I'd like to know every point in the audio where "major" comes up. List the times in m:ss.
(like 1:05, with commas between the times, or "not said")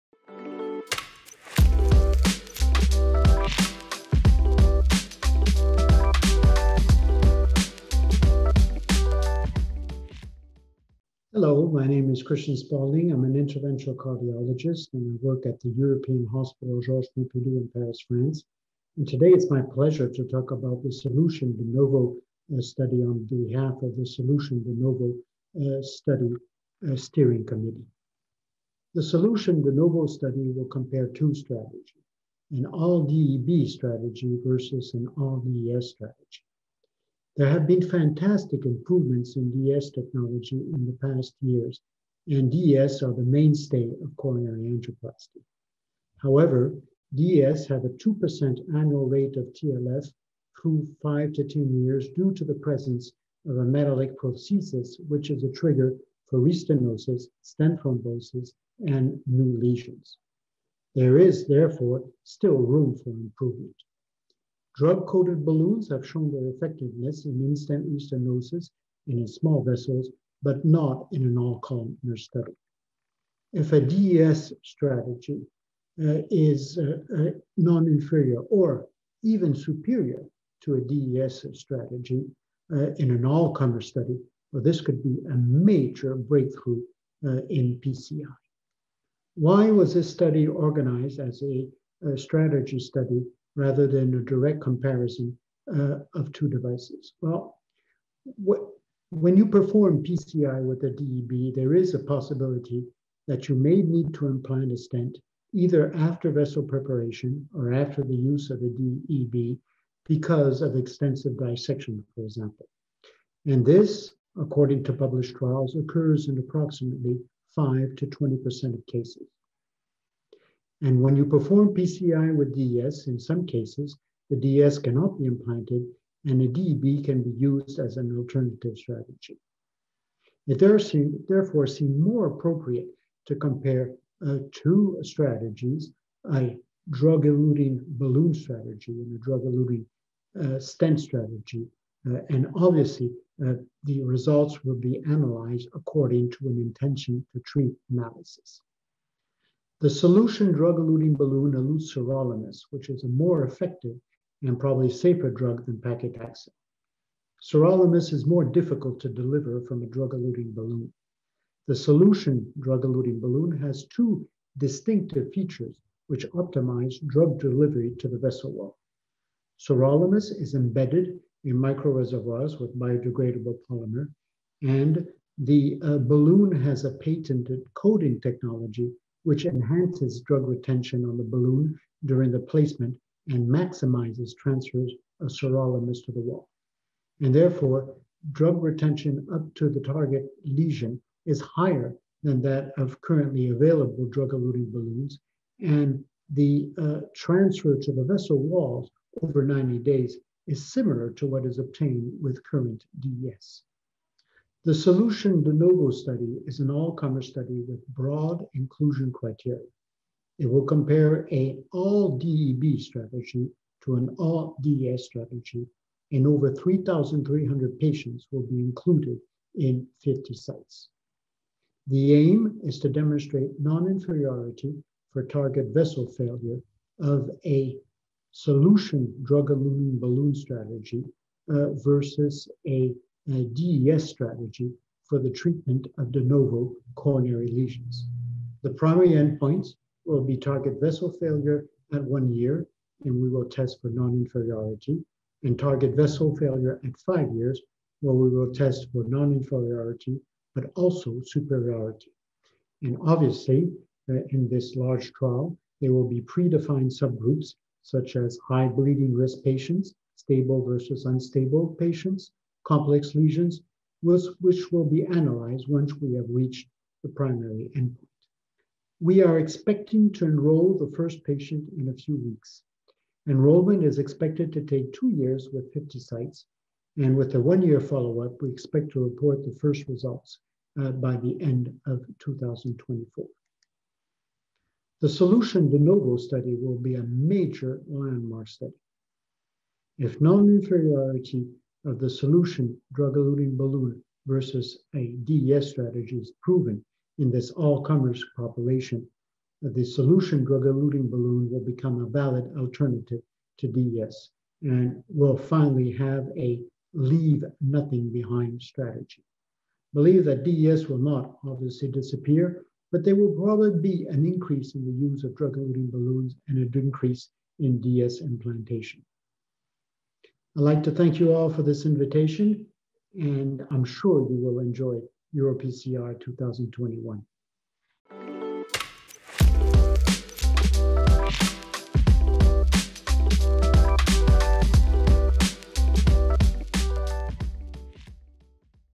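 1:25, 4:47.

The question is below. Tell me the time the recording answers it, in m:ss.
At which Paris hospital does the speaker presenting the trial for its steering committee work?
0:15.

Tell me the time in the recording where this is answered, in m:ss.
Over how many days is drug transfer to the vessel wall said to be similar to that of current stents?
3:19.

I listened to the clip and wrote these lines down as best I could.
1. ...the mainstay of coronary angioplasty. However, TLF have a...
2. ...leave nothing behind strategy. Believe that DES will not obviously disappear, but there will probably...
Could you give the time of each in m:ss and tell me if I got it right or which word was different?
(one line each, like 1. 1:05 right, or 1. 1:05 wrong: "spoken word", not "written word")
1. 0:43 wrong: "DES", not "TLF"
2. 5:06 right.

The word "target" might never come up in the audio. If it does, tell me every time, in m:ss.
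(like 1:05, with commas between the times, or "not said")
3:09, 3:45, 4:00, 4:05.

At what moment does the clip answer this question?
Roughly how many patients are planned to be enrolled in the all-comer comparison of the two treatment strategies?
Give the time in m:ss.
3:36.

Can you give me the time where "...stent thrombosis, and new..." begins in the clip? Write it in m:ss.
0:57.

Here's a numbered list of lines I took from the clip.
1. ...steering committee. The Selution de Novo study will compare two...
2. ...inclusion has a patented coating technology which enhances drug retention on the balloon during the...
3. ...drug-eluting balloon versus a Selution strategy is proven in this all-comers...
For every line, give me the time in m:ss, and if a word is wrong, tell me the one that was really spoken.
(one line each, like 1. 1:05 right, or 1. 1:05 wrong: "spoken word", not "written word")
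1. 0:26 right
2. 2:55 wrong: "balloon", not "inclusion"
3. 4:52 wrong: "DES", not "Selution".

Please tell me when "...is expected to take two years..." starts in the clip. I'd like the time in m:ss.
4:33.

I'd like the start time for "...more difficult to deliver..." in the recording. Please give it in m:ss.
2:38.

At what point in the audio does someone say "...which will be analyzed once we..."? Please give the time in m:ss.
4:24.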